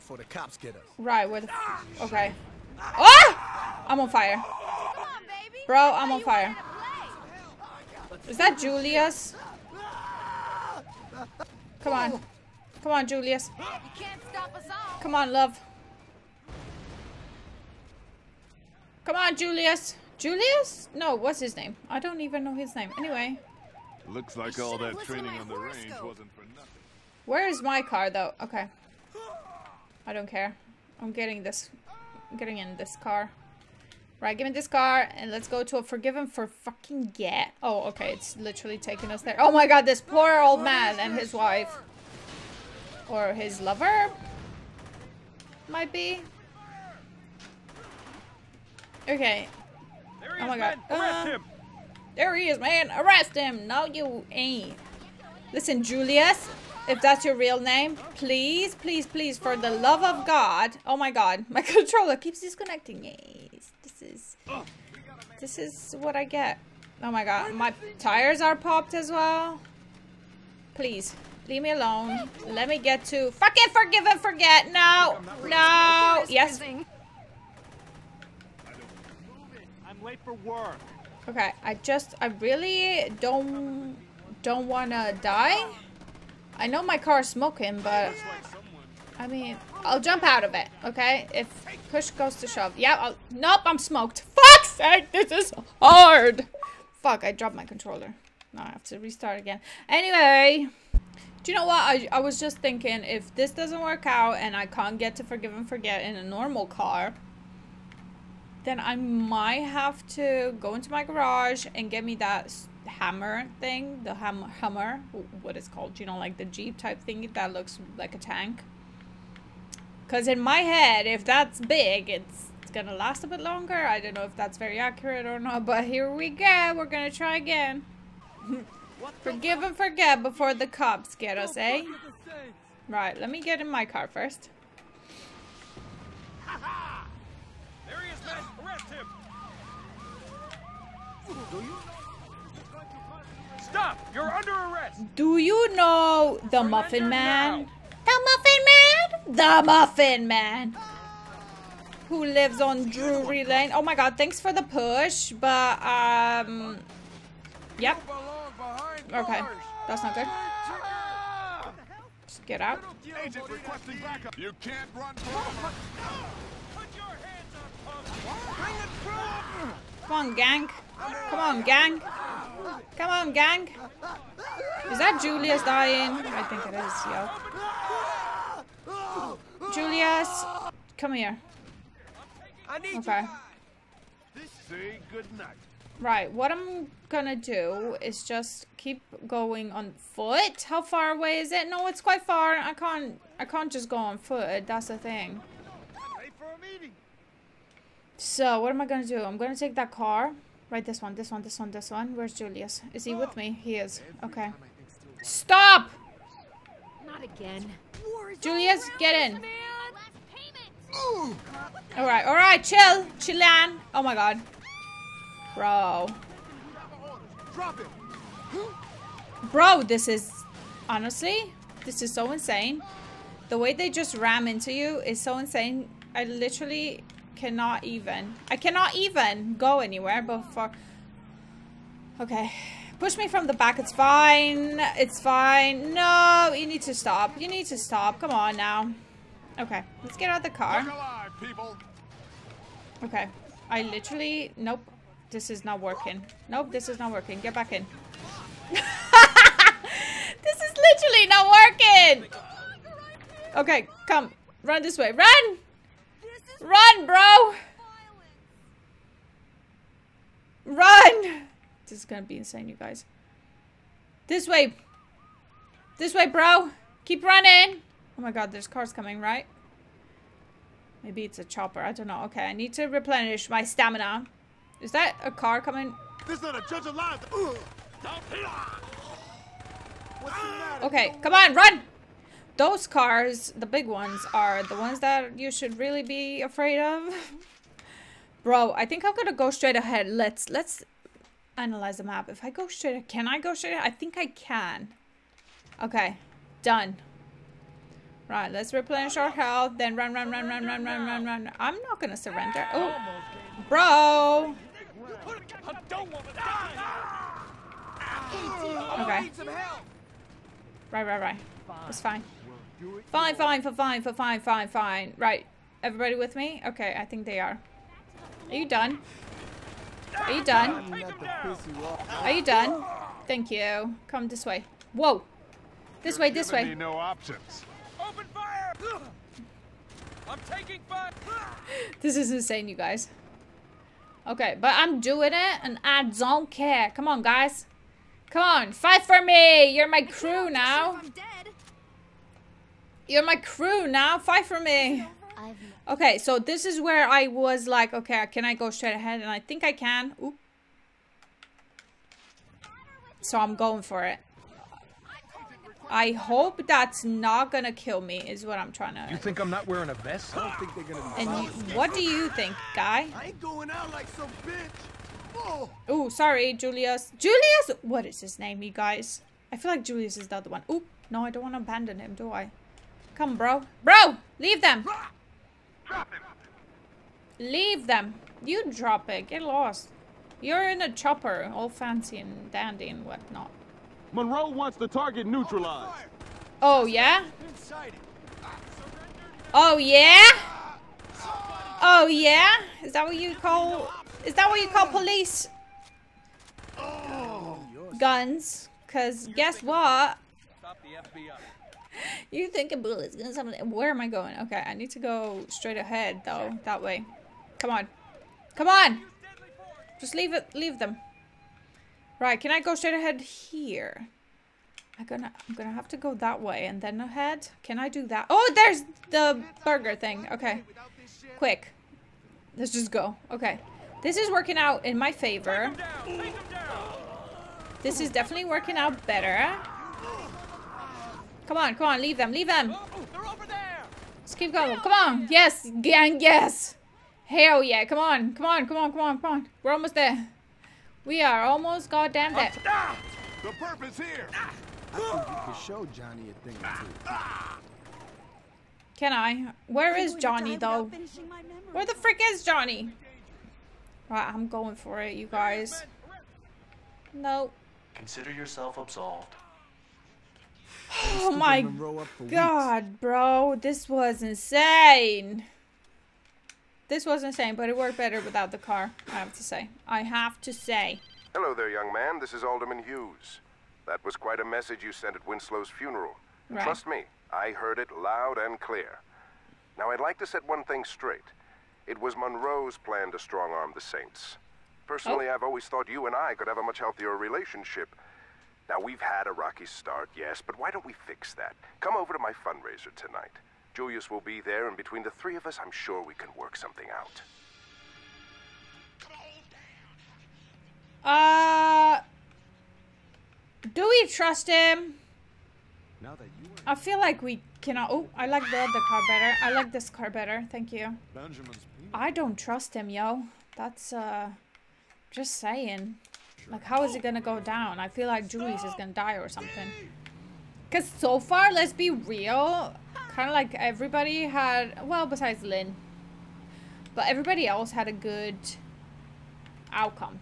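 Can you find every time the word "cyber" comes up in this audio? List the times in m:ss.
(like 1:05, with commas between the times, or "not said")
not said.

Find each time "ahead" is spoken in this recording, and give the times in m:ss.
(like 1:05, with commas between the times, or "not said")
4:49, 5:48, 6:45, 6:52, 6:56.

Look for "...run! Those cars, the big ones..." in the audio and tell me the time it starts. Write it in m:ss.
4:41.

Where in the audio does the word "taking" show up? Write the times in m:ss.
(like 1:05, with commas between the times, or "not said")
0:38, 5:30.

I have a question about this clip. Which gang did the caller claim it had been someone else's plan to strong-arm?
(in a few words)
The Saints.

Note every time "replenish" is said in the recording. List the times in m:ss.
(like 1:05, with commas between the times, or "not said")
4:32, 4:58.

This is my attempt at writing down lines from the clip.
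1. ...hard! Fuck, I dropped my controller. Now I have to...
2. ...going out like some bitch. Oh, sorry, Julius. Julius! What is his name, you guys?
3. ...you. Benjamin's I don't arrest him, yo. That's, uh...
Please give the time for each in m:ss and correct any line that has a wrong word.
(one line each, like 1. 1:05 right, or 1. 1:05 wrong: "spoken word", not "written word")
1. 1:35 right
2. 6:03 right
3. 8:30 wrong: "trust", not "arrest".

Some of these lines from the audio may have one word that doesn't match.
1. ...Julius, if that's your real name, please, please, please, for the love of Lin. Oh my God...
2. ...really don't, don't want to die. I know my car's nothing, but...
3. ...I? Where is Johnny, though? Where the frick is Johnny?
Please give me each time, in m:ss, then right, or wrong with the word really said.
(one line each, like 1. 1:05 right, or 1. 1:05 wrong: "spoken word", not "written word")
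1. 0:55 wrong: "God", not "Lin"
2. 1:22 wrong: "smoking", not "nothing"
3. 7:29 right.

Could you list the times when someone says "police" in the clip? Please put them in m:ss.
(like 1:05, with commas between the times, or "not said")
6:34.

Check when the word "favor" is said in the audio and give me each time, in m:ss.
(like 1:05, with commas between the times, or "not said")
7:05.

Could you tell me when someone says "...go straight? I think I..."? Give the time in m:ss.
4:53.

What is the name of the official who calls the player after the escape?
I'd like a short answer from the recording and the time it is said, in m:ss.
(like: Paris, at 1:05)
Alderman Hughes, at 7:52.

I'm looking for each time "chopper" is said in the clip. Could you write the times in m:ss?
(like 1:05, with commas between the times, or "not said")
4:31, 6:20.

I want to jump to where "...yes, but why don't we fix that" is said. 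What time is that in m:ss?
8:10.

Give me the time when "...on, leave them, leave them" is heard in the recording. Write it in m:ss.
7:11.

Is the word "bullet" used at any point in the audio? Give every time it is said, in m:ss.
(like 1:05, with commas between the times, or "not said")
6:42.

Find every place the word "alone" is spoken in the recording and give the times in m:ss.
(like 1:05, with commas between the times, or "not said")
1:11.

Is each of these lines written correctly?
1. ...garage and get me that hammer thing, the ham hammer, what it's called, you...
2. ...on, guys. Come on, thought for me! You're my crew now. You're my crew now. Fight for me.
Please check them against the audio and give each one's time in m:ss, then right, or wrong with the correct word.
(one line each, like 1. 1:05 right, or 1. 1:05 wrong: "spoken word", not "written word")
1. 1:51 right
2. 5:37 wrong: "fight", not "thought".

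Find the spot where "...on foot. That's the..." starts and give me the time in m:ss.
3:13.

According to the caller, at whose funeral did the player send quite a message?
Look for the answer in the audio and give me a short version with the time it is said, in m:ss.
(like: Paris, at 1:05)
Winslow, at 7:55.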